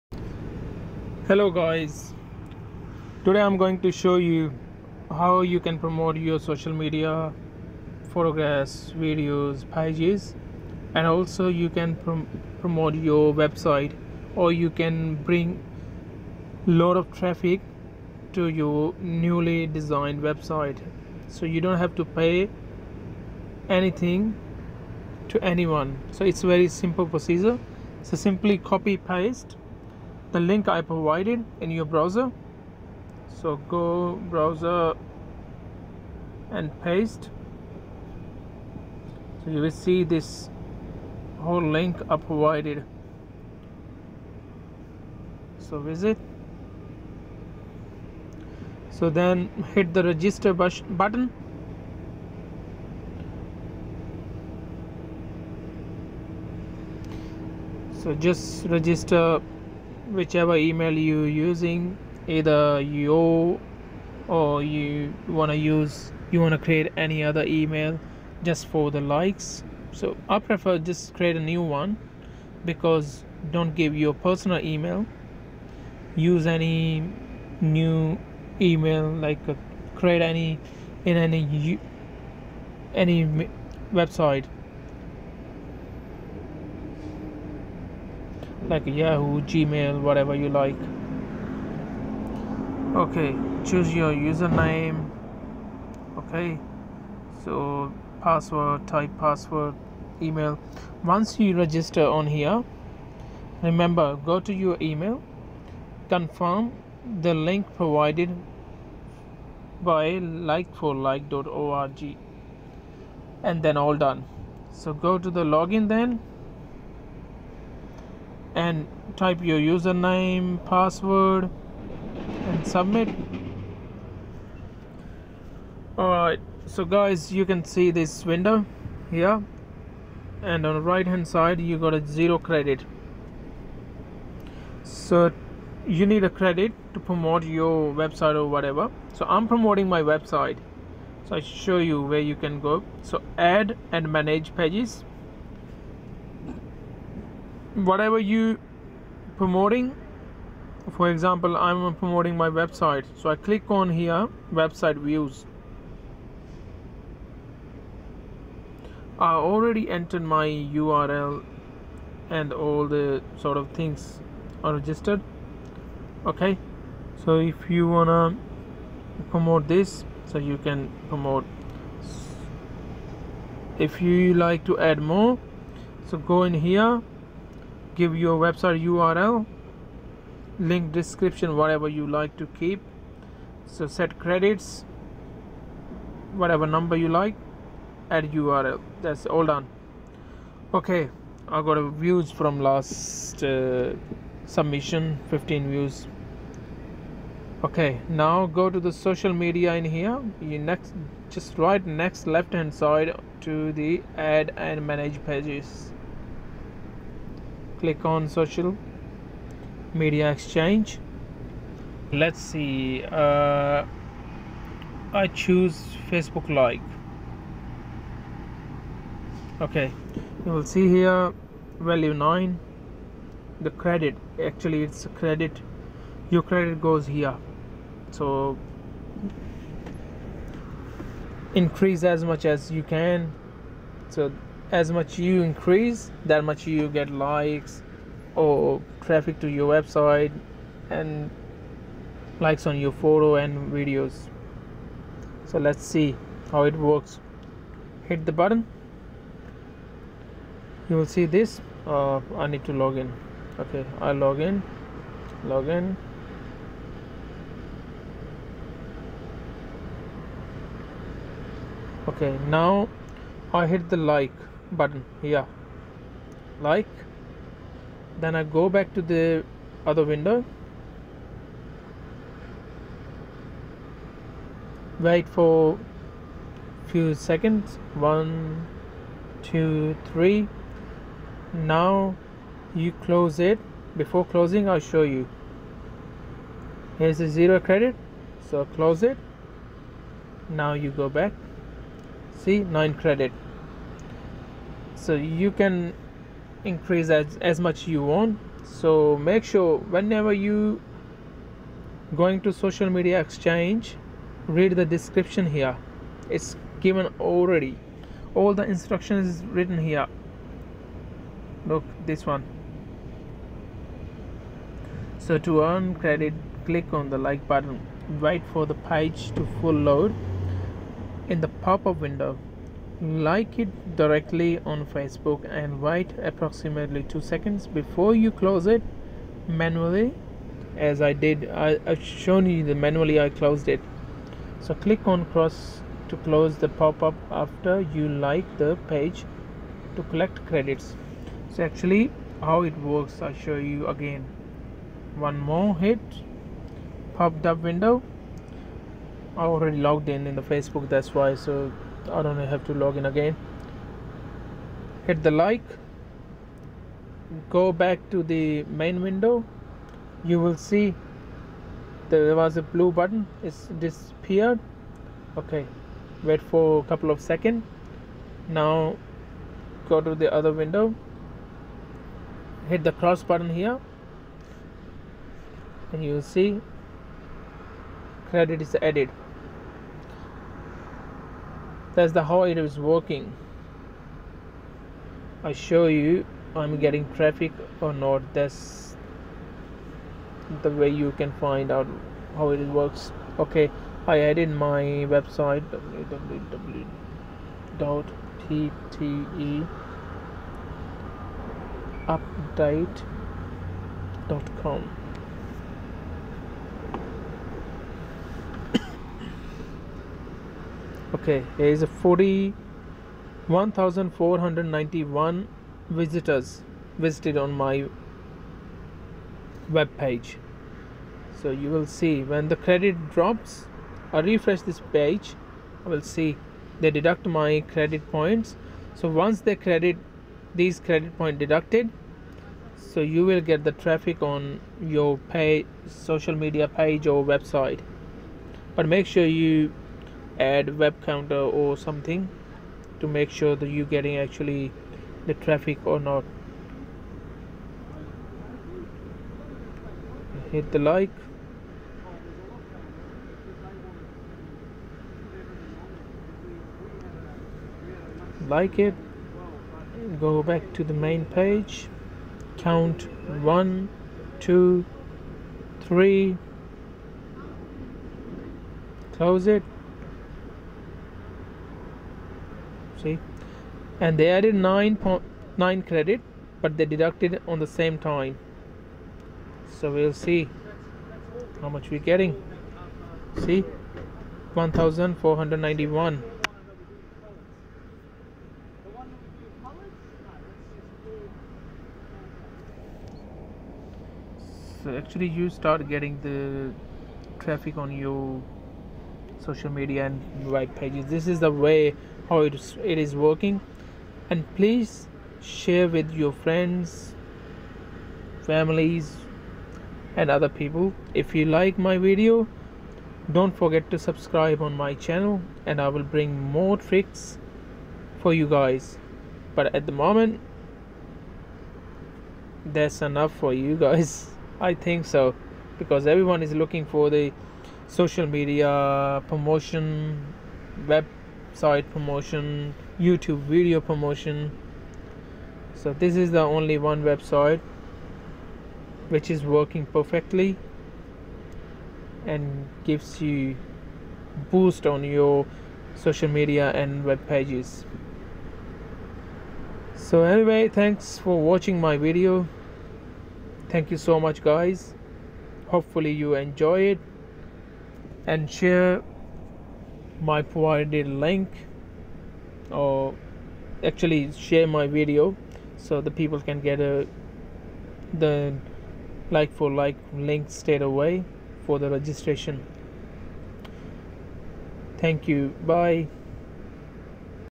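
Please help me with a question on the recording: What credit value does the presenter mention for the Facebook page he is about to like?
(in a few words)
9.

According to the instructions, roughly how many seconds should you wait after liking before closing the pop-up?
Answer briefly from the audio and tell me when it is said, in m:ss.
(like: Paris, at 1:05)
2 seconds, at 5:27.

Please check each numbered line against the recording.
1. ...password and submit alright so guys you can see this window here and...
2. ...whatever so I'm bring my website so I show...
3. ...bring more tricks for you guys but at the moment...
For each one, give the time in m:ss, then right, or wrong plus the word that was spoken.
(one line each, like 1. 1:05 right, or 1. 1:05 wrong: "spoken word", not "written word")
1. 2:00 right
2. 2:18 wrong: "promoting", not "bring"
3. 8:36 right.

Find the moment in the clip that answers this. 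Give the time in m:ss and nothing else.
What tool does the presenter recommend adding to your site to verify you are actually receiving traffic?
7:20.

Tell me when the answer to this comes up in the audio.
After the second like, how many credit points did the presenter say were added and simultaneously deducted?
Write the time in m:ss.
7:54.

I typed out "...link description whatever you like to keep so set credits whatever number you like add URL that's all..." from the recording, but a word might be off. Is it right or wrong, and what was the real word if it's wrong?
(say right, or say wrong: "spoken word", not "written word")
right.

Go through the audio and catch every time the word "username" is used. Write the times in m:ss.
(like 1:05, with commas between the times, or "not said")
1:34, 1:59.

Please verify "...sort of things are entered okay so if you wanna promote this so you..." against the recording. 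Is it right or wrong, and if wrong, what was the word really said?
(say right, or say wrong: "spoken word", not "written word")
wrong: "registered", not "entered".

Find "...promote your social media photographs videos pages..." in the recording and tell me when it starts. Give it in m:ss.
0:05.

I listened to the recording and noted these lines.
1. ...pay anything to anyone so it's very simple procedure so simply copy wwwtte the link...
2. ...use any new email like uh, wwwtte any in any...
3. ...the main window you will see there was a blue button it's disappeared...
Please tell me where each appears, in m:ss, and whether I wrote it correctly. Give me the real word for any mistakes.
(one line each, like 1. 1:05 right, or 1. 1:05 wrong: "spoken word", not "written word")
1. 0:22 wrong: "paste", not "wwwtte"
2. 1:16 wrong: "create", not "wwwtte"
3. 5:58 right.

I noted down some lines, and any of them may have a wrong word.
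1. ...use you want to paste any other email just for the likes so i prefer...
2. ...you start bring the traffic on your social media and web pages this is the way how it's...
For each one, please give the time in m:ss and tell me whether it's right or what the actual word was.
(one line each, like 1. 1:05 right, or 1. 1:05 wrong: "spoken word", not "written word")
1. 1:05 wrong: "create", not "paste"
2. 8:15 wrong: "getting", not "bring".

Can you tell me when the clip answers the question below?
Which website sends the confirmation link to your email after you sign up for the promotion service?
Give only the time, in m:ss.
1:50.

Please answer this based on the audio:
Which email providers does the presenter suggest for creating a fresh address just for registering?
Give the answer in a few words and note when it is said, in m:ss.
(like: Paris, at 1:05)
Yahoo, Gmail, at 1:28.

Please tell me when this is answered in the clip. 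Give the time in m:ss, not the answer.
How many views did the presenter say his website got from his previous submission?
3:15.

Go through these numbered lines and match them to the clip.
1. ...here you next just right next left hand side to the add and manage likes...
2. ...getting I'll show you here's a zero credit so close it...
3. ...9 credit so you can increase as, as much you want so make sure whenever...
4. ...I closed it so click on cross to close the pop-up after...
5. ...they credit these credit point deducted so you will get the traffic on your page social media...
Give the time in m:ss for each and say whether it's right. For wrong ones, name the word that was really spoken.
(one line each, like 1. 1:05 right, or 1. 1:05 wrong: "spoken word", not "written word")
1. 3:19 wrong: "pages", not "likes"
2. 4:44 wrong: "closing", not "getting"
3. 4:52 right
4. 5:33 right
5. 7:09 right.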